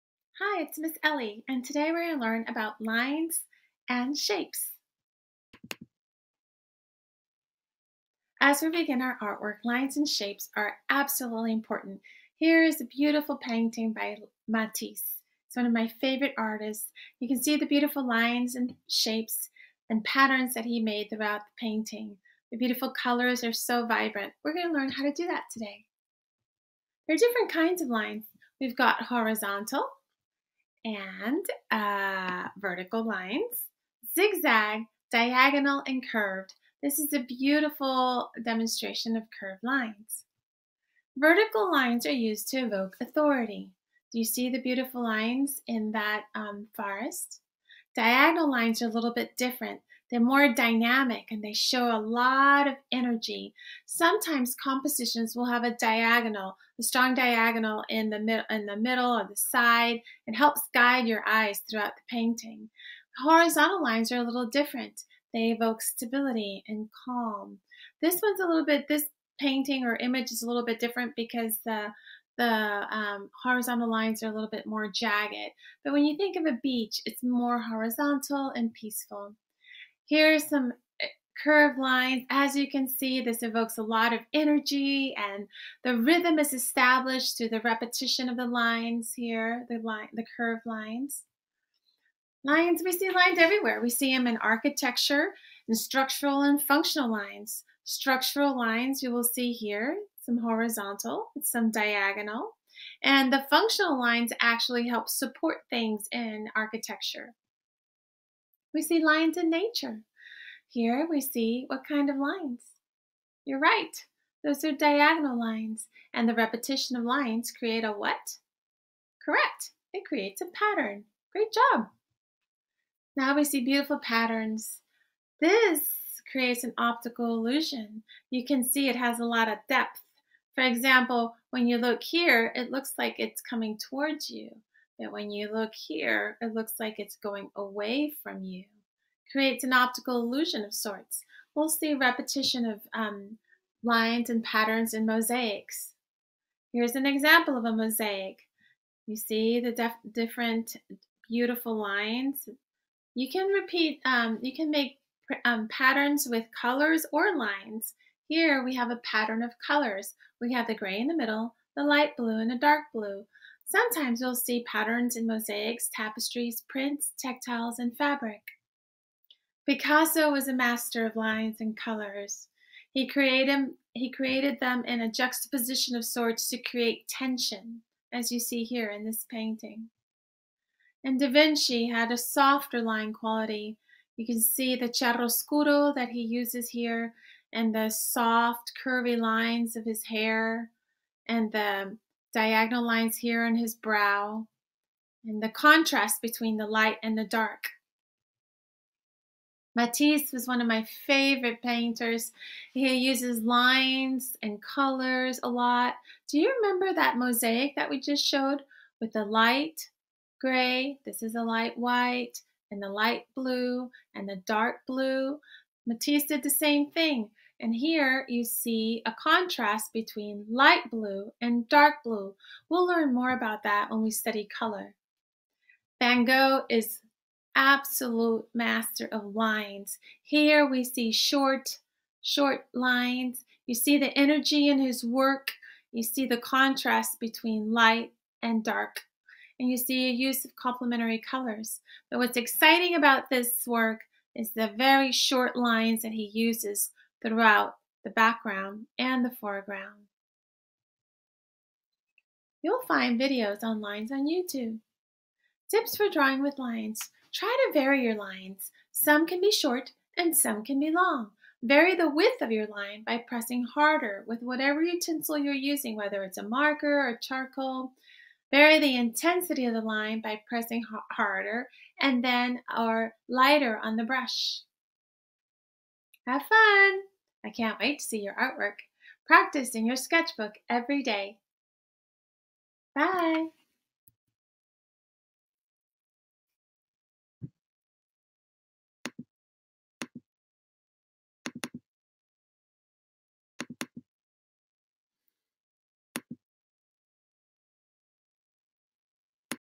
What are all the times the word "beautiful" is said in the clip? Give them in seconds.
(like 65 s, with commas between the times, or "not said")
12 s, 17 s, 22 s, 37 s, 44 s, 123 s, 151 s.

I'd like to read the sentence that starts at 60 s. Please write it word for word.
It helps guide your eyes throughout the painting.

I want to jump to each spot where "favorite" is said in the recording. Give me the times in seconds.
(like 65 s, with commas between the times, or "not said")
16 s, 201 s.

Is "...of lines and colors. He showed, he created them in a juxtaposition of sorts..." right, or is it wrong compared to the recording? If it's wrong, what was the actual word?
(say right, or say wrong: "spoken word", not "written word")
wrong: "created", not "showed".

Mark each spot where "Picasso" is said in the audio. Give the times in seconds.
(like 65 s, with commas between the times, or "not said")
169 s.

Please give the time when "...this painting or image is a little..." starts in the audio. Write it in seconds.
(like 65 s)
68 s.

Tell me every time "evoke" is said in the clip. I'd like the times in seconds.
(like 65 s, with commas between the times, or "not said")
42 s, 65 s, 83 s.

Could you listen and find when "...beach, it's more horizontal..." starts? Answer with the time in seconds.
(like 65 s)
76 s.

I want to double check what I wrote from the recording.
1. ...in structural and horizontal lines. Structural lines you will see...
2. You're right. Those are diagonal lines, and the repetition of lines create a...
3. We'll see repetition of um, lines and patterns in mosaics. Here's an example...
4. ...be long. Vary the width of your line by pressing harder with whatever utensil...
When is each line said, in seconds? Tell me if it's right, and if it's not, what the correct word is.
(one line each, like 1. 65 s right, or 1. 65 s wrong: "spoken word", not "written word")
1. 95 s wrong: "functional", not "horizontal"
2. 113 s right
3. 141 s right
4. 260 s right.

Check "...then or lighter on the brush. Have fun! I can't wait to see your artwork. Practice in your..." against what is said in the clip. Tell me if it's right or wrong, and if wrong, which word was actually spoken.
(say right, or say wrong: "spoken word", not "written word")
right.